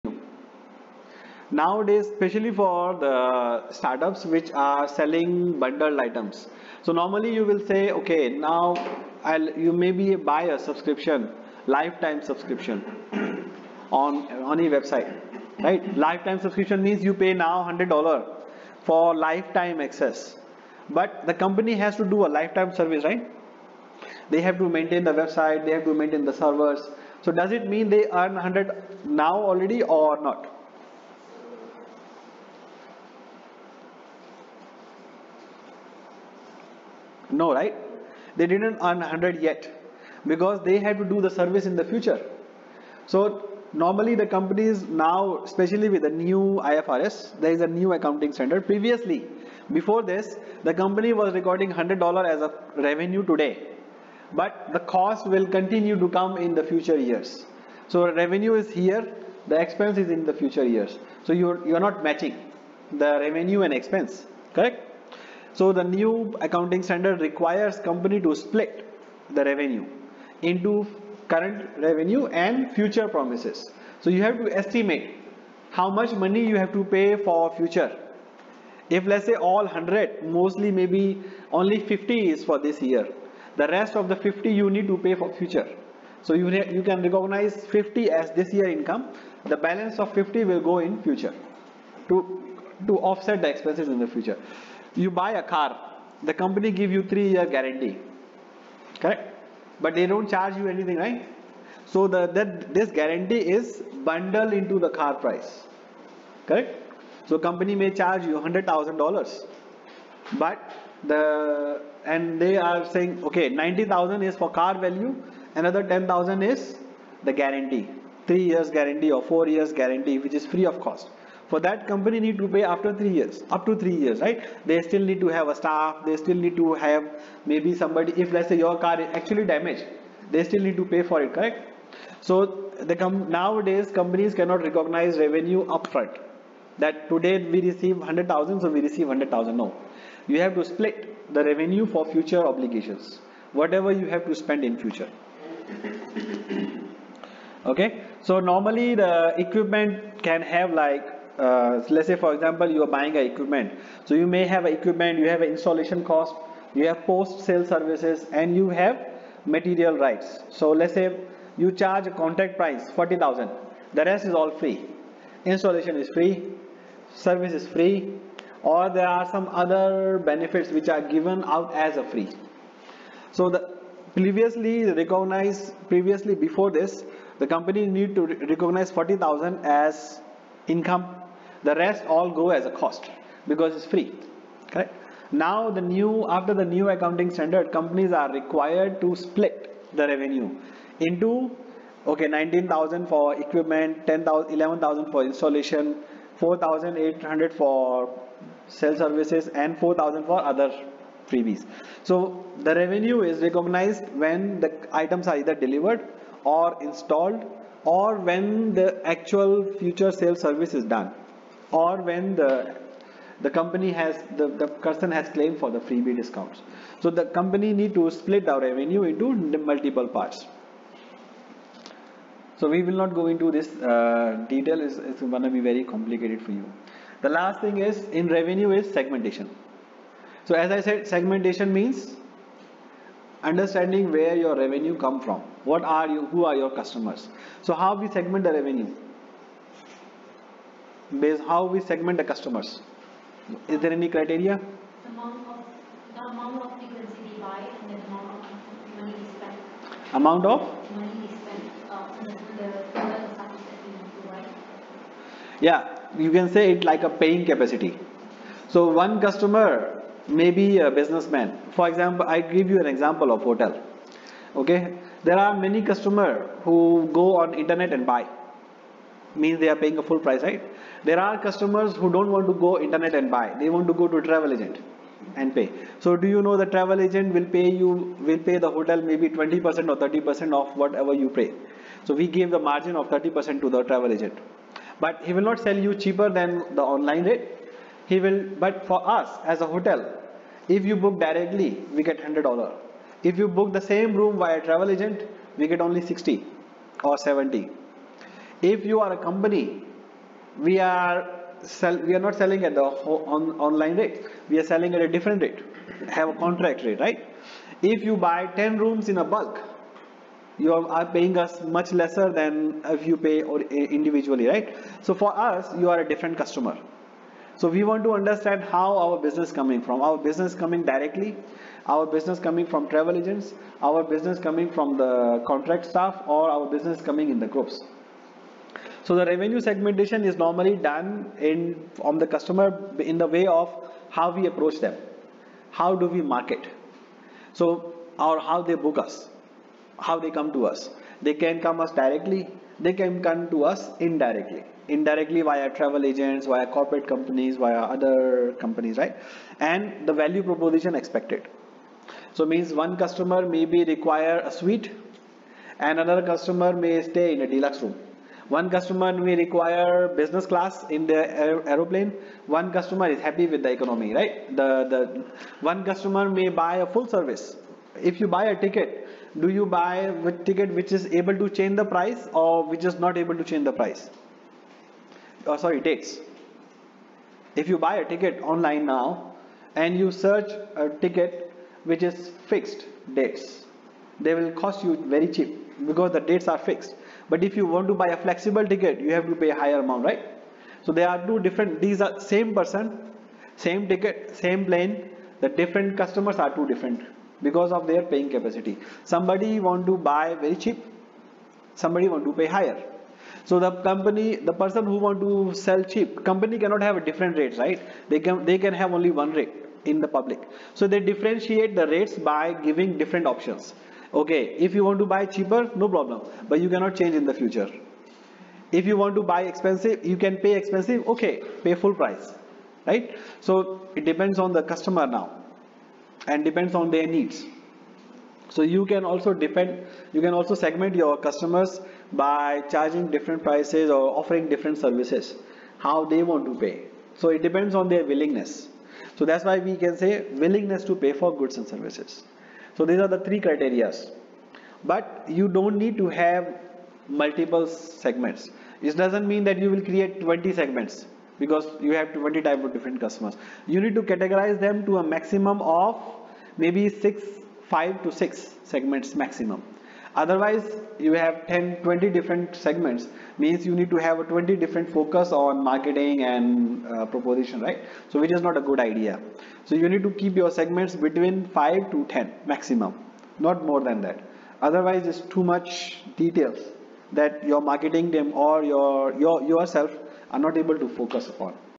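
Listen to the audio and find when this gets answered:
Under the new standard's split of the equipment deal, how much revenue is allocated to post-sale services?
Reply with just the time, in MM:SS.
03:16.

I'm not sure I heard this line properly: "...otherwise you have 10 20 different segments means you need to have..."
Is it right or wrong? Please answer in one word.
right.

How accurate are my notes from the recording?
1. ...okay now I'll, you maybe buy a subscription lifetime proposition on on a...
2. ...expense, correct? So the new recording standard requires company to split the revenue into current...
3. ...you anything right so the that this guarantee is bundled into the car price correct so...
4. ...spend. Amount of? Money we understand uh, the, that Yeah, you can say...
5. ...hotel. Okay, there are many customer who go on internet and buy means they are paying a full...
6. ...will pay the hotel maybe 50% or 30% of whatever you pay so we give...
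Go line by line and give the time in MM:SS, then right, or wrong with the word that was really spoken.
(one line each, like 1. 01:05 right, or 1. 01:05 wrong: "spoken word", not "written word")
1. 00:07 wrong: "subscription", not "proposition"
2. 01:03 wrong: "accounting", not "recording"
3. 01:40 right
4. 04:09 wrong: "spend", not "understand"
5. 04:23 right
6. 04:38 wrong: "20", not "50".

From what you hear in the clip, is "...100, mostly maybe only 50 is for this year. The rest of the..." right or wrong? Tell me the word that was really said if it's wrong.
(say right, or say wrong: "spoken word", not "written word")
right.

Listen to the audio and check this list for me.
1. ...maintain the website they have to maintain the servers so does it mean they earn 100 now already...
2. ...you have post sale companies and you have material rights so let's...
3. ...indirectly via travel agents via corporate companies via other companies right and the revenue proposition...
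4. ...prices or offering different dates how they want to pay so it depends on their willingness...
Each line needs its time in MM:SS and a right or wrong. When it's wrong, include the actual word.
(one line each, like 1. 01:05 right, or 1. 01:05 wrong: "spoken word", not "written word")
1. 00:24 right
2. 02:36 wrong: "services", not "companies"
3. 05:44 wrong: "value", not "revenue"
4. 07:13 wrong: "services", not "dates".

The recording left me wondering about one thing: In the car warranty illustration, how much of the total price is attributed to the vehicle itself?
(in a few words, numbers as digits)
90,000.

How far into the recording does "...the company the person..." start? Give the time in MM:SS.
06:43.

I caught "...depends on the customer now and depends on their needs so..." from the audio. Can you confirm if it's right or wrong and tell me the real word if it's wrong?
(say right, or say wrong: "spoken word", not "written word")
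right.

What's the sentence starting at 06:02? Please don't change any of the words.
One customer is happy with the economy, right?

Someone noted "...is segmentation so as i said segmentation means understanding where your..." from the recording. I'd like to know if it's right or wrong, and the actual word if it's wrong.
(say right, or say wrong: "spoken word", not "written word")
right.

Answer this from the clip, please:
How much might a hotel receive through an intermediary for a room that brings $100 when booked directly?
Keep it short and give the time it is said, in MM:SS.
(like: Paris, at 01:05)
60 or 70, at 04:56.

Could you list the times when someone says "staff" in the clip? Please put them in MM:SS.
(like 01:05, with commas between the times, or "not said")
02:05, 05:25.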